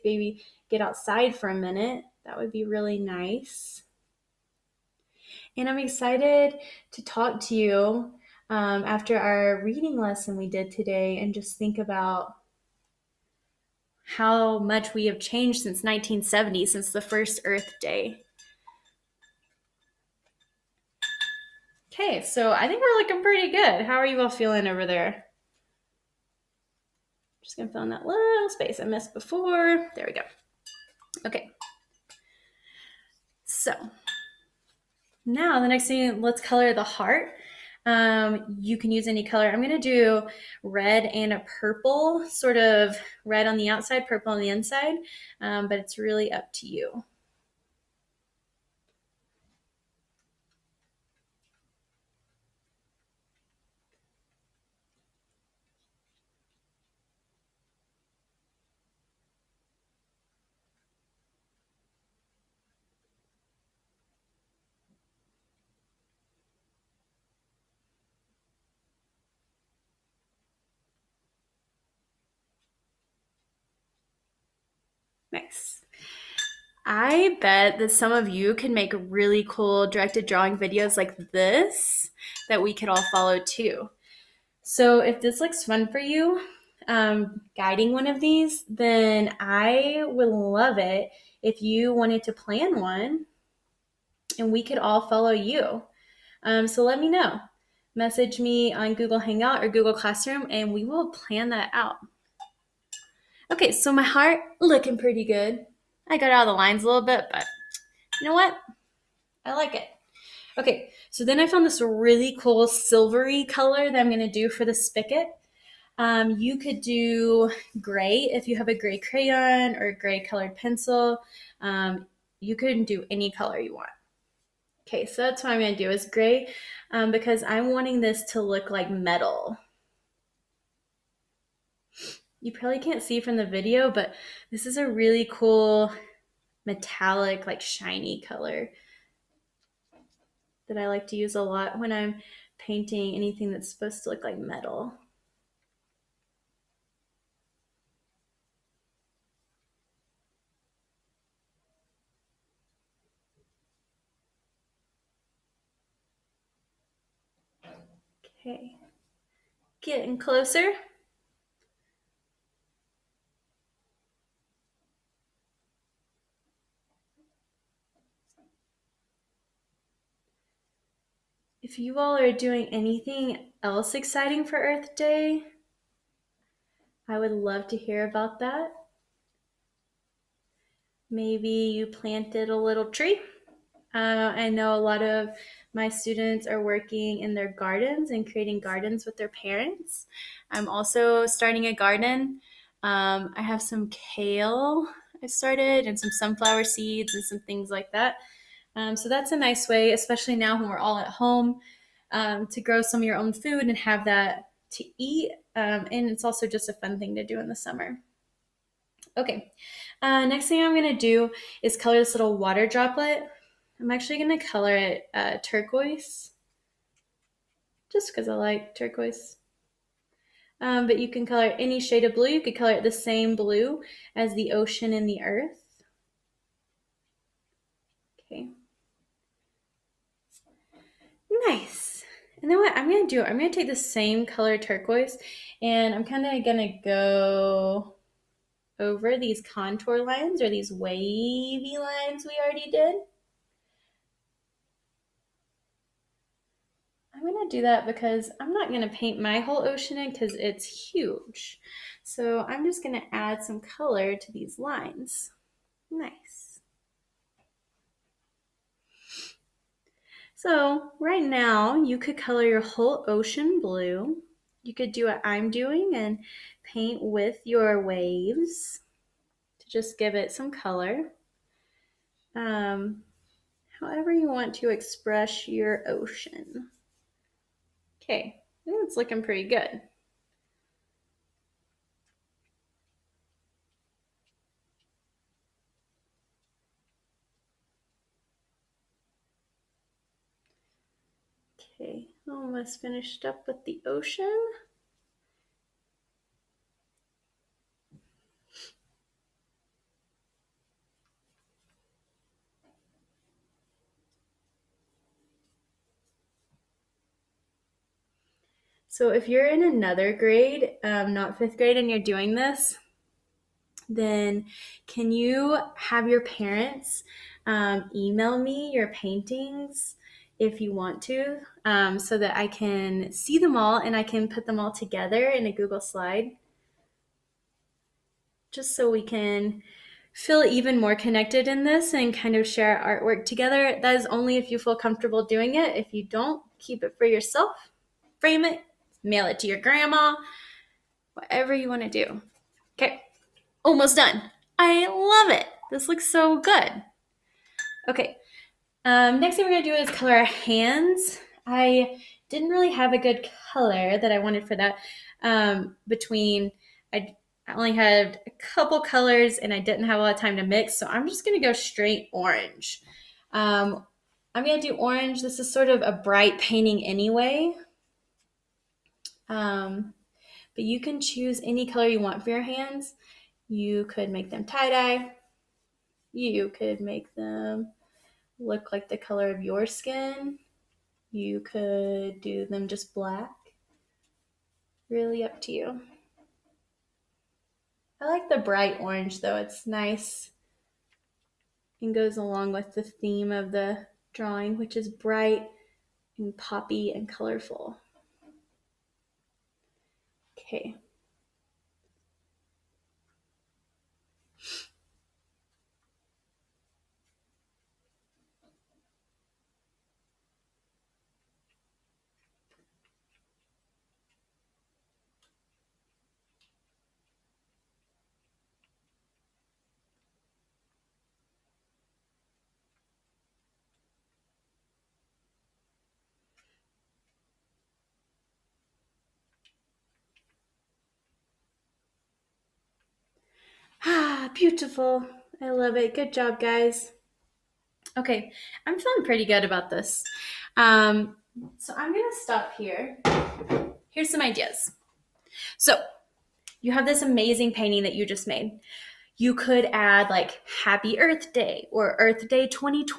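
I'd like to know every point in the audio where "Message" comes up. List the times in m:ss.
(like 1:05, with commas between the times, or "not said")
1:37.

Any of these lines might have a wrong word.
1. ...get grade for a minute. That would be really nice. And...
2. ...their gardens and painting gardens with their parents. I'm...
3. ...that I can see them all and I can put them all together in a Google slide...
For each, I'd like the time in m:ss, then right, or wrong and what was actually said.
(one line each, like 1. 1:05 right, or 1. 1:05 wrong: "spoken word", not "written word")
1. 0:00 wrong: "outside", not "grade"
2. 3:07 wrong: "creating", not "painting"
3. 5:22 right.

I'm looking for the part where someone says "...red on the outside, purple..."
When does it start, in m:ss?
0:43.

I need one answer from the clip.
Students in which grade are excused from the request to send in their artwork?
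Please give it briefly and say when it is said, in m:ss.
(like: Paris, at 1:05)
fifth grade, at 5:11.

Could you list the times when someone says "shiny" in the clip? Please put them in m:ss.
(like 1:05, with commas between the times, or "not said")
2:17.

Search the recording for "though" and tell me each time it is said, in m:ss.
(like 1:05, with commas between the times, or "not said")
6:29.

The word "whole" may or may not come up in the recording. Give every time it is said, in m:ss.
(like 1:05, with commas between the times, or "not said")
4:09, 4:22.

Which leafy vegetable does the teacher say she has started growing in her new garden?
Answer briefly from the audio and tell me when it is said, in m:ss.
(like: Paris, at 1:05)
kale, at 3:13.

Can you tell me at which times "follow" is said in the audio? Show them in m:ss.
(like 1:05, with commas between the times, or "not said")
1:23, 1:35.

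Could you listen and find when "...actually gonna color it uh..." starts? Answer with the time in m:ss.
3:33.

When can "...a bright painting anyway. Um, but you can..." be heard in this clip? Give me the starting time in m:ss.
6:05.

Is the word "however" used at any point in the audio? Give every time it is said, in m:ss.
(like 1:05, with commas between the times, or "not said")
4:33.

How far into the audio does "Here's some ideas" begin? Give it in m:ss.
7:23.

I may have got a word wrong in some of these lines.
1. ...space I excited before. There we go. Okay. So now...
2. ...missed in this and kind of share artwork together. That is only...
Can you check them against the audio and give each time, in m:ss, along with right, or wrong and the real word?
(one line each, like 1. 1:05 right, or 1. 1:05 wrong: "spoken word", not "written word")
1. 0:28 wrong: "missed", not "excited"
2. 5:30 wrong: "connected", not "missed".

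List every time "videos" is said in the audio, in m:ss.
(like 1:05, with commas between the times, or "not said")
1:20, 2:13.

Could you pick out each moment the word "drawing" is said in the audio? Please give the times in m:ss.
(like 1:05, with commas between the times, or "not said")
1:20, 6:34.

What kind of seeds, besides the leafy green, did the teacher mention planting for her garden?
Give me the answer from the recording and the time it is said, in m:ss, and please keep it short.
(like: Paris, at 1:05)
sunflower seeds, at 3:16.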